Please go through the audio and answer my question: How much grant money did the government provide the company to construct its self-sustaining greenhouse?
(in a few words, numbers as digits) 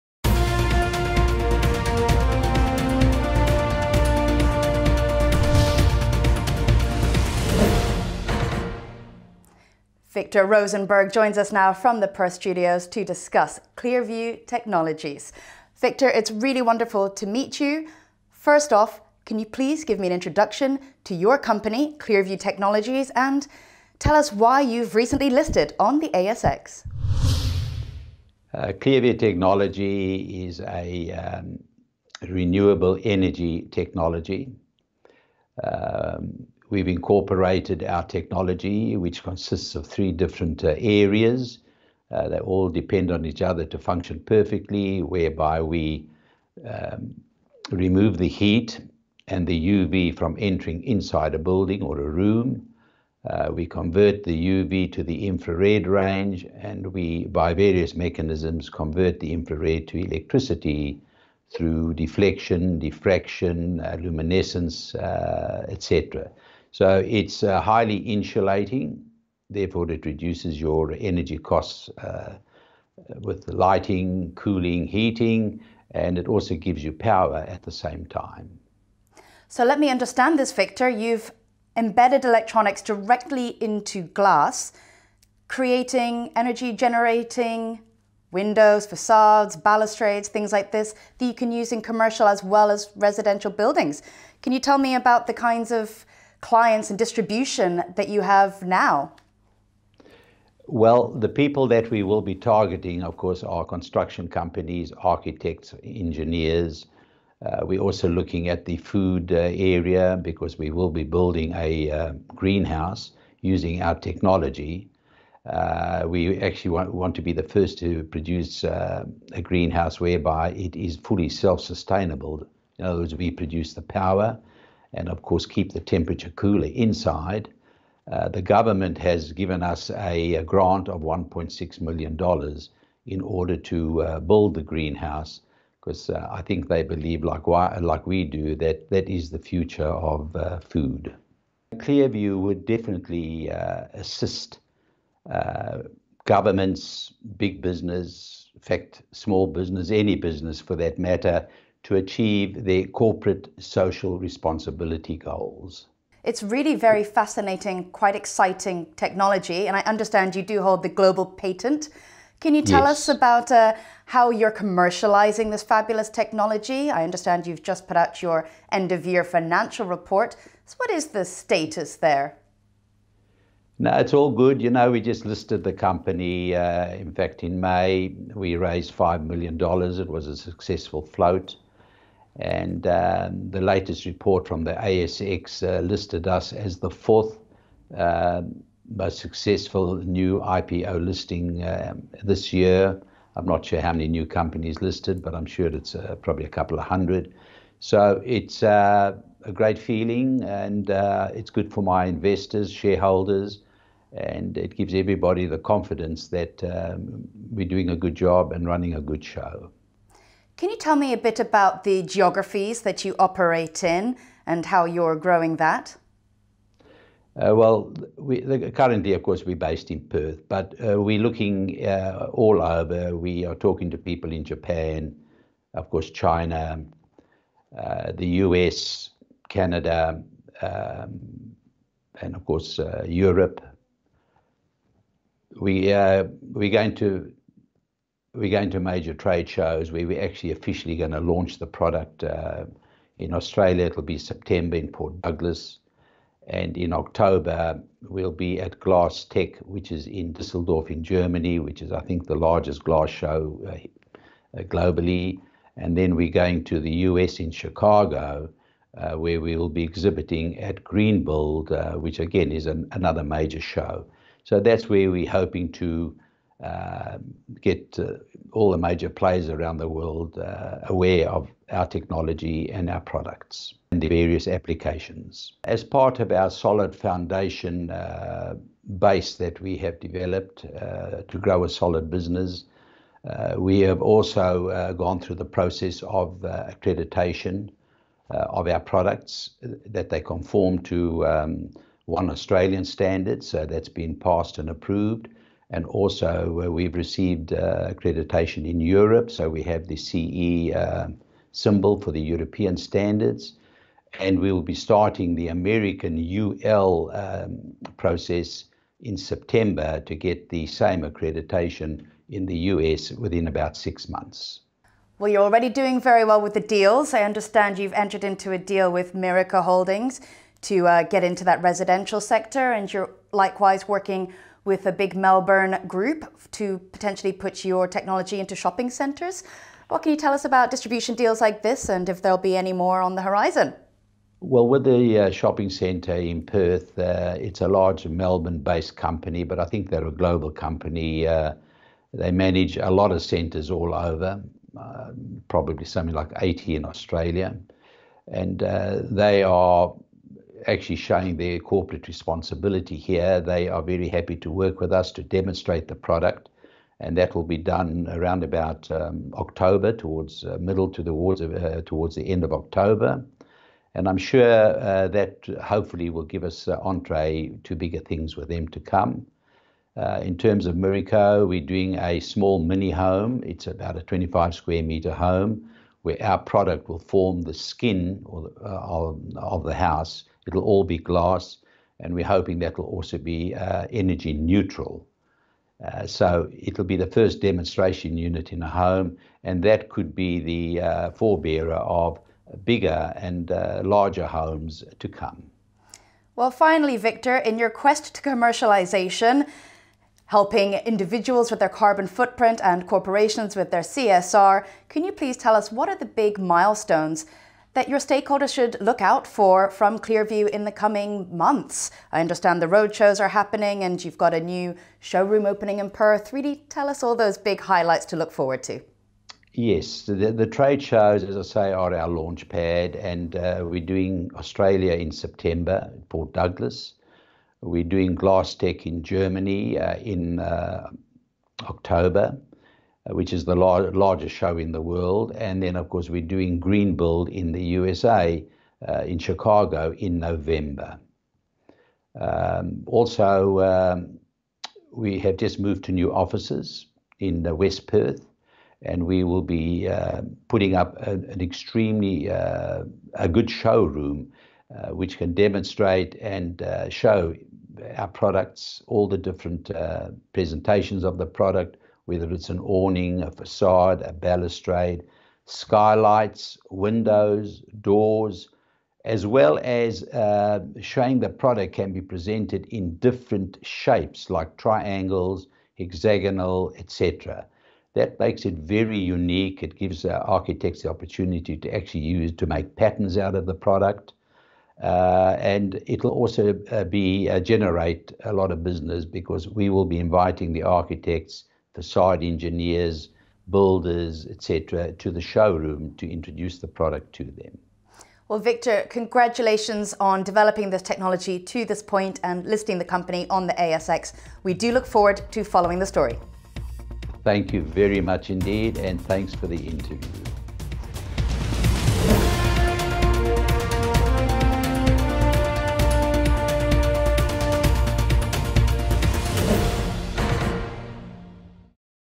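$1.6 million.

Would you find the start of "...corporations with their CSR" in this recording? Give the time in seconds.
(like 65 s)
402 s.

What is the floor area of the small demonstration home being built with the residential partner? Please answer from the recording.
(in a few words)
25 square meters.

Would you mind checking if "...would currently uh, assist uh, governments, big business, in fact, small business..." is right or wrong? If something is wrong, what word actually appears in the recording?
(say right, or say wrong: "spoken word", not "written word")
wrong: "definitely", not "currently".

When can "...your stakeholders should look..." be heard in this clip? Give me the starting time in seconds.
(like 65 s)
407 s.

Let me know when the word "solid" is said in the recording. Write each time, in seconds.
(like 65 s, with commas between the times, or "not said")
276 s, 281 s.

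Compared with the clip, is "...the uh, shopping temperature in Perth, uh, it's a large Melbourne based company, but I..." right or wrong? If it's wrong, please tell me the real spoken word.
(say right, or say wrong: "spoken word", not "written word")
wrong: "centre", not "temperature".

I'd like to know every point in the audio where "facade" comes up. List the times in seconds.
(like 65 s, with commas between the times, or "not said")
88 s, 463 s, 491 s.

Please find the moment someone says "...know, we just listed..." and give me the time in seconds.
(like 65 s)
174 s.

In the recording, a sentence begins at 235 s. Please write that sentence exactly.
We, uh, we're going to we're going to major trade shows where we're actually officially going to launch the product.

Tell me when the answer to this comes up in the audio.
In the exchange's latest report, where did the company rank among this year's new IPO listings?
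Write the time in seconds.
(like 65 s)
186 s.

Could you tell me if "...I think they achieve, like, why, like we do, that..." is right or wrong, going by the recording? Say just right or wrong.
wrong.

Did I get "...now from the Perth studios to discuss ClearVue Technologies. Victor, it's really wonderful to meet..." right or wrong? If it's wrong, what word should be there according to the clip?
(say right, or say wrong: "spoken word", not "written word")
right.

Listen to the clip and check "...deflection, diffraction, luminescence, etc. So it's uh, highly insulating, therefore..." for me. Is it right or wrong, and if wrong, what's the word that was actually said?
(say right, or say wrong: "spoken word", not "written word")
right.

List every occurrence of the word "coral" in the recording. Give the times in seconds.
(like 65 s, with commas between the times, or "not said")
not said.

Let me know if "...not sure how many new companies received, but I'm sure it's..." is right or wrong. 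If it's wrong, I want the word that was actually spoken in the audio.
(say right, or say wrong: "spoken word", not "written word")
wrong: "listed", not "received".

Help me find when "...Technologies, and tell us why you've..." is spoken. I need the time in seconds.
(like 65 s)
22 s.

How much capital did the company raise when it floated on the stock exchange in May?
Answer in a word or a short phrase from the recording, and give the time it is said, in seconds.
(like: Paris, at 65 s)
$5 million, at 178 s.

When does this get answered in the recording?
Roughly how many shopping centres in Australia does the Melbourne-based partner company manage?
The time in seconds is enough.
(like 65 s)
346 s.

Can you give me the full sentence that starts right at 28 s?
Uh, ClearVue Technology is a um, renewable energy technology.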